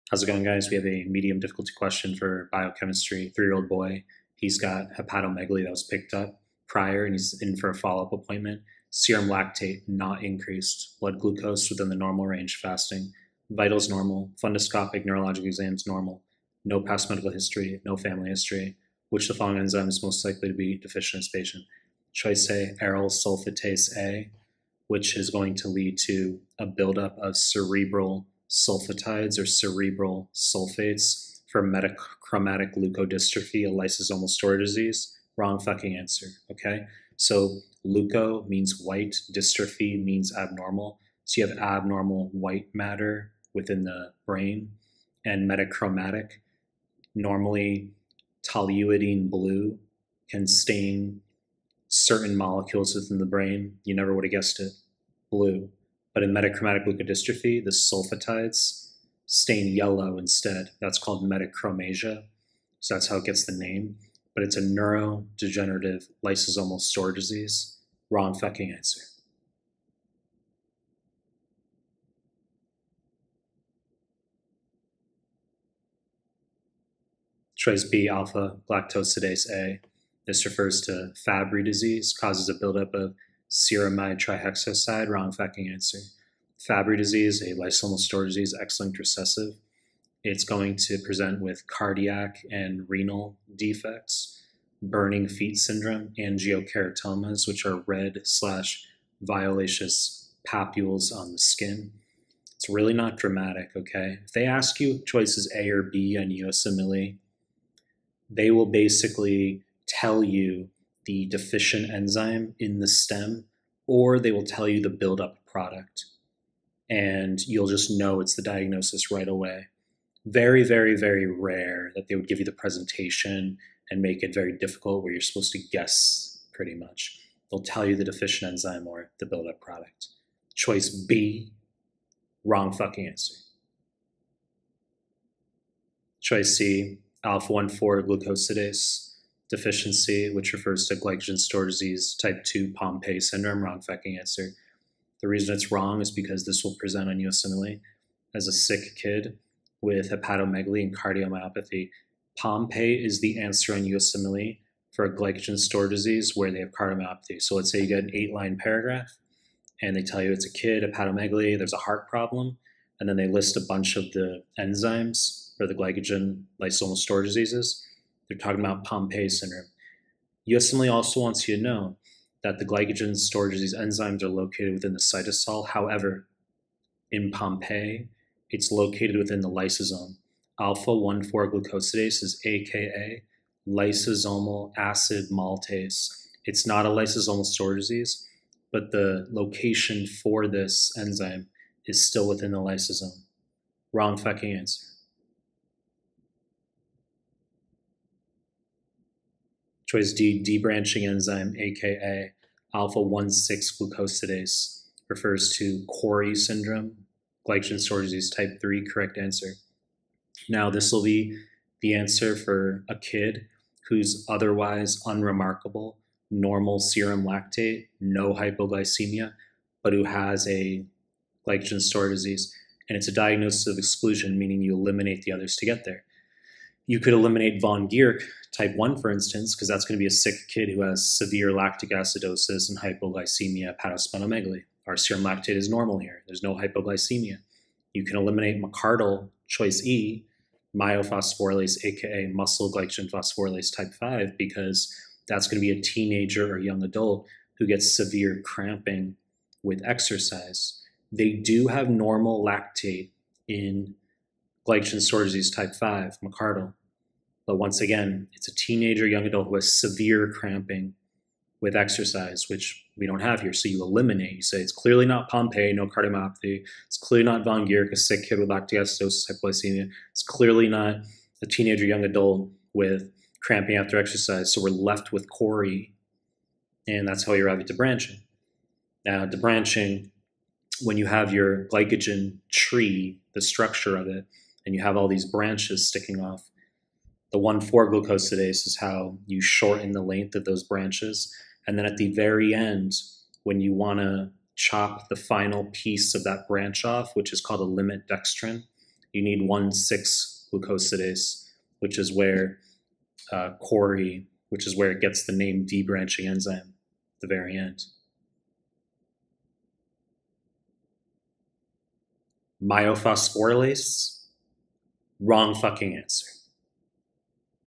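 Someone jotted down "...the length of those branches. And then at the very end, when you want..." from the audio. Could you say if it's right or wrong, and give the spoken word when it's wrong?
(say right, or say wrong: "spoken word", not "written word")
right.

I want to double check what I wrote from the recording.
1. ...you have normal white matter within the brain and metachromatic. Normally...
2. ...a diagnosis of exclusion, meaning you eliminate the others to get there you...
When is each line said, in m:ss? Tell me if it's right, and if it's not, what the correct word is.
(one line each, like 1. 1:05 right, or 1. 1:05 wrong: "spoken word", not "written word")
1. 0:41 wrong: "abnormal", not "normal"
2. 3:43 right.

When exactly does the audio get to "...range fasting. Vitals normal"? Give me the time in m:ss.
0:12.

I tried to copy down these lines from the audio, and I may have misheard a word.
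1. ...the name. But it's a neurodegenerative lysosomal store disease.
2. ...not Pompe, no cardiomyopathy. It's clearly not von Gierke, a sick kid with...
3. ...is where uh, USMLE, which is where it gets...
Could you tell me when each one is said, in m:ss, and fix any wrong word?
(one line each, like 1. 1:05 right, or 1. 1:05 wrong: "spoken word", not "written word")
1. 1:03 right
2. 4:25 right
3. 5:01 wrong: "Cori", not "USMLE".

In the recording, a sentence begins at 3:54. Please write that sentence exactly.
Our serum lactate is normal here.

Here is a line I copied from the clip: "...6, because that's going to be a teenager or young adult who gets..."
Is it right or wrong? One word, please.
wrong.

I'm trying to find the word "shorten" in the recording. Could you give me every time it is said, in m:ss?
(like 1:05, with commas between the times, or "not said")
4:49.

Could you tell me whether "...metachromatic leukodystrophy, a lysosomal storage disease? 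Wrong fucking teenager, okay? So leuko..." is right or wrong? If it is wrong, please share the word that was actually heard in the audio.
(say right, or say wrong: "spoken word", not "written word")
wrong: "answer", not "teenager".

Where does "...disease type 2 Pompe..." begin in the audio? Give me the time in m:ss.
2:21.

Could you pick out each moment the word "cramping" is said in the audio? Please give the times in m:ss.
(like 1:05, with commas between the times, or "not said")
4:08, 4:20, 4:33.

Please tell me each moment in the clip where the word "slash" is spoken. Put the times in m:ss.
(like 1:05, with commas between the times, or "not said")
1:38.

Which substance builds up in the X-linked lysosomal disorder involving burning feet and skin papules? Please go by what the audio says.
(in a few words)
Ceramide trihexoside.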